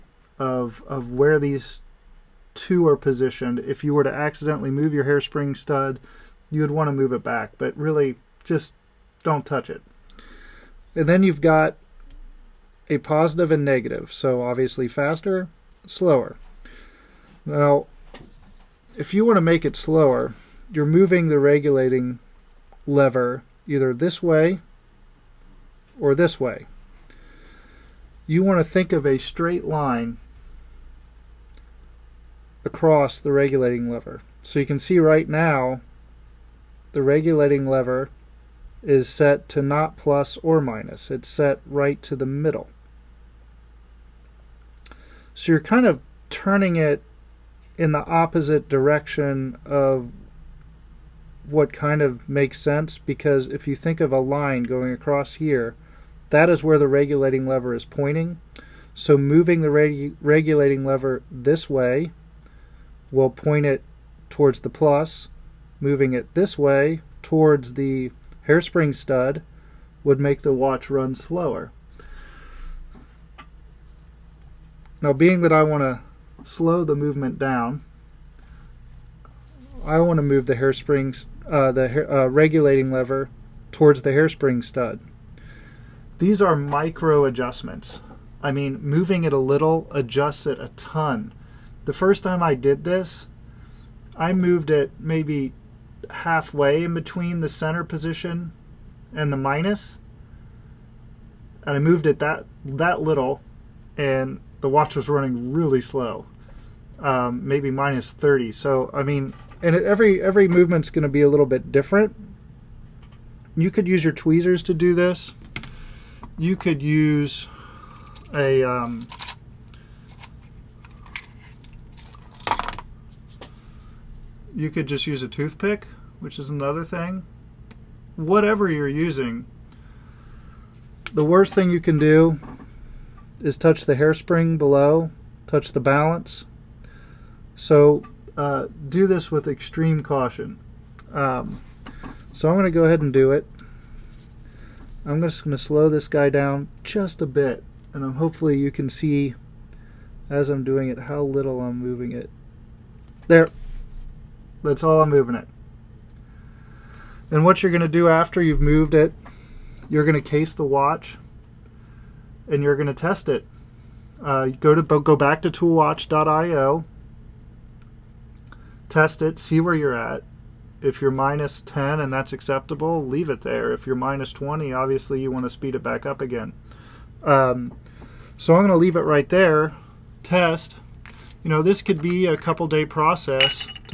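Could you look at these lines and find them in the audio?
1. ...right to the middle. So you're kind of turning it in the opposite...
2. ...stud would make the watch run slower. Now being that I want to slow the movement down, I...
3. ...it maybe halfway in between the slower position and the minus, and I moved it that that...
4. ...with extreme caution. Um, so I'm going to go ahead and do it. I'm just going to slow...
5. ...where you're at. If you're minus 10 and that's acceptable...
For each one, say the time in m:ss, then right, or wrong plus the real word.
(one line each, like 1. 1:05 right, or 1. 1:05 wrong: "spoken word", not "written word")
1. 0:41 right
2. 1:08 right
3. 1:34 wrong: "center", not "slower"
4. 2:19 right
5. 2:49 right.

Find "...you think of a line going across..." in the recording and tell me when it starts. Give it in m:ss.
0:53.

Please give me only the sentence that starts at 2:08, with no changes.
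Whatever you're using, the worst thing you can do is touch the hairspring below, touch the balance.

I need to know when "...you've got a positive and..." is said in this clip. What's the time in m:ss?
0:11.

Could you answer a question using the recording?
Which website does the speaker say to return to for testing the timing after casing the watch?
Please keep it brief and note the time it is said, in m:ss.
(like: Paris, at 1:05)
toolwatch.io, at 2:45.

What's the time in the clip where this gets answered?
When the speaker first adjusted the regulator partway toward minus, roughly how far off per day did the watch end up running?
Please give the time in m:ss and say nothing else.
1:47.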